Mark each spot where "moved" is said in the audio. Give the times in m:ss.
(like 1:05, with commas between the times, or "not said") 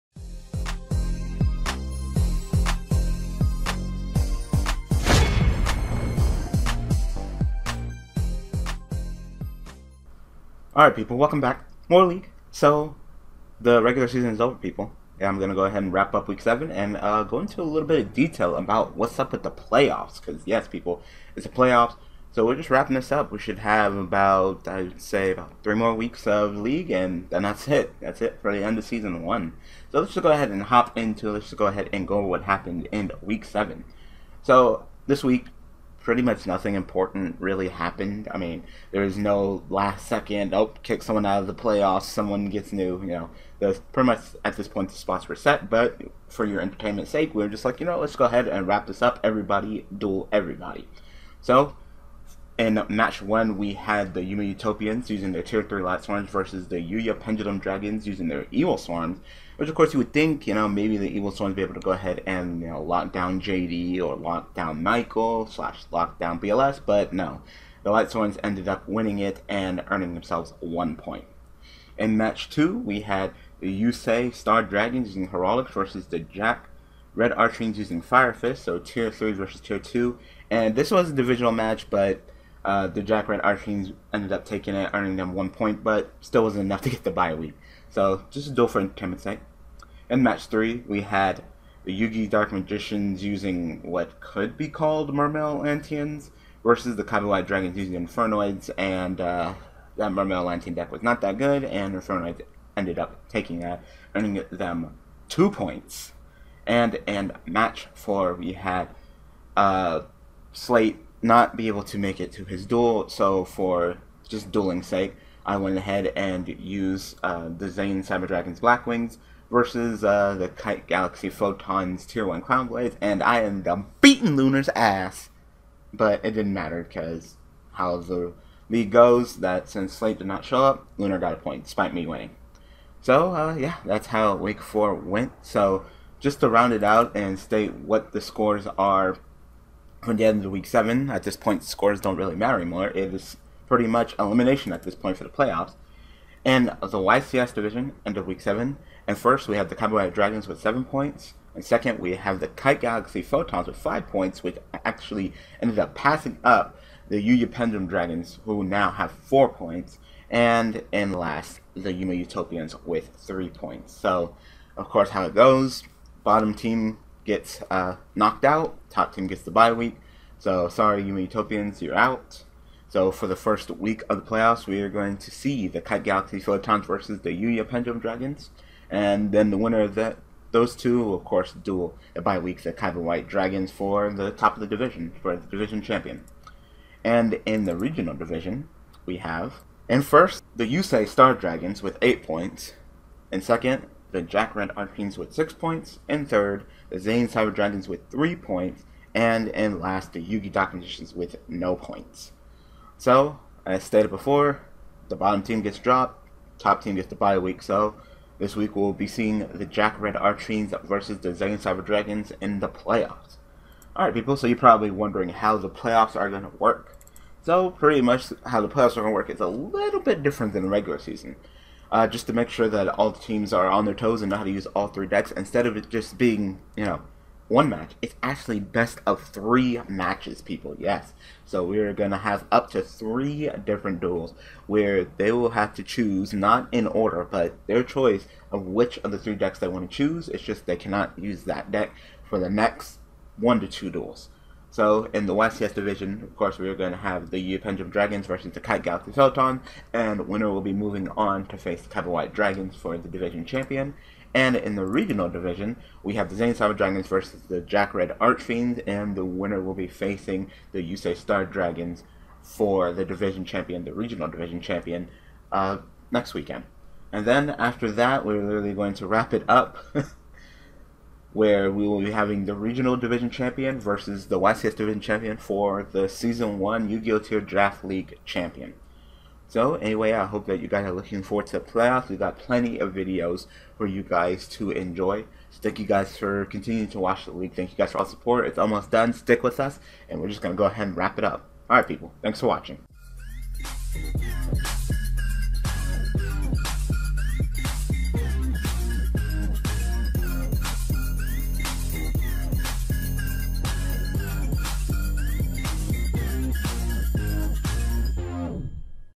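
not said.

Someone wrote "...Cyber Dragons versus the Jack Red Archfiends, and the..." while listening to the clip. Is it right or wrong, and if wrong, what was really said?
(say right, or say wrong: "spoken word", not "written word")
right.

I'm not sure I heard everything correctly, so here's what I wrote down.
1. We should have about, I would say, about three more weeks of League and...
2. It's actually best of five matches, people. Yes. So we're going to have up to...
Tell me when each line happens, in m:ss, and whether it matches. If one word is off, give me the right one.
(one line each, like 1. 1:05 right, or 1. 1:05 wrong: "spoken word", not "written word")
1. 0:23 right
2. 3:48 wrong: "three", not "five".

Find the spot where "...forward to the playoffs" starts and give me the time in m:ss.
4:41.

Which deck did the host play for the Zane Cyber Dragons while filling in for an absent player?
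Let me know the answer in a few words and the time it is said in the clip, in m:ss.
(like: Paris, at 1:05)
Blackwings, at 1:58.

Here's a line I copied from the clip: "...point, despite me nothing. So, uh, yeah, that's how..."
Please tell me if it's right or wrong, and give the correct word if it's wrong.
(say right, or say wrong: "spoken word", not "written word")
wrong: "winning", not "nothing".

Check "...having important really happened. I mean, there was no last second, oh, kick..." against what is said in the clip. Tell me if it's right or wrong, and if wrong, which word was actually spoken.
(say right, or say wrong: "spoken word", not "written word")
wrong: "nothing", not "having".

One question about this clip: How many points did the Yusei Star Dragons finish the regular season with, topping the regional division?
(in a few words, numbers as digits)
8.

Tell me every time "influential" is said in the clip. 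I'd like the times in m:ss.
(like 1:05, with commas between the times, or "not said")
not said.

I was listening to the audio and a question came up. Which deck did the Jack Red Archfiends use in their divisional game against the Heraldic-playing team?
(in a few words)
Fire Fist.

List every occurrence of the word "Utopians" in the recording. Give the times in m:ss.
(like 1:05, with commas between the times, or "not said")
0:54, 2:42, 2:51.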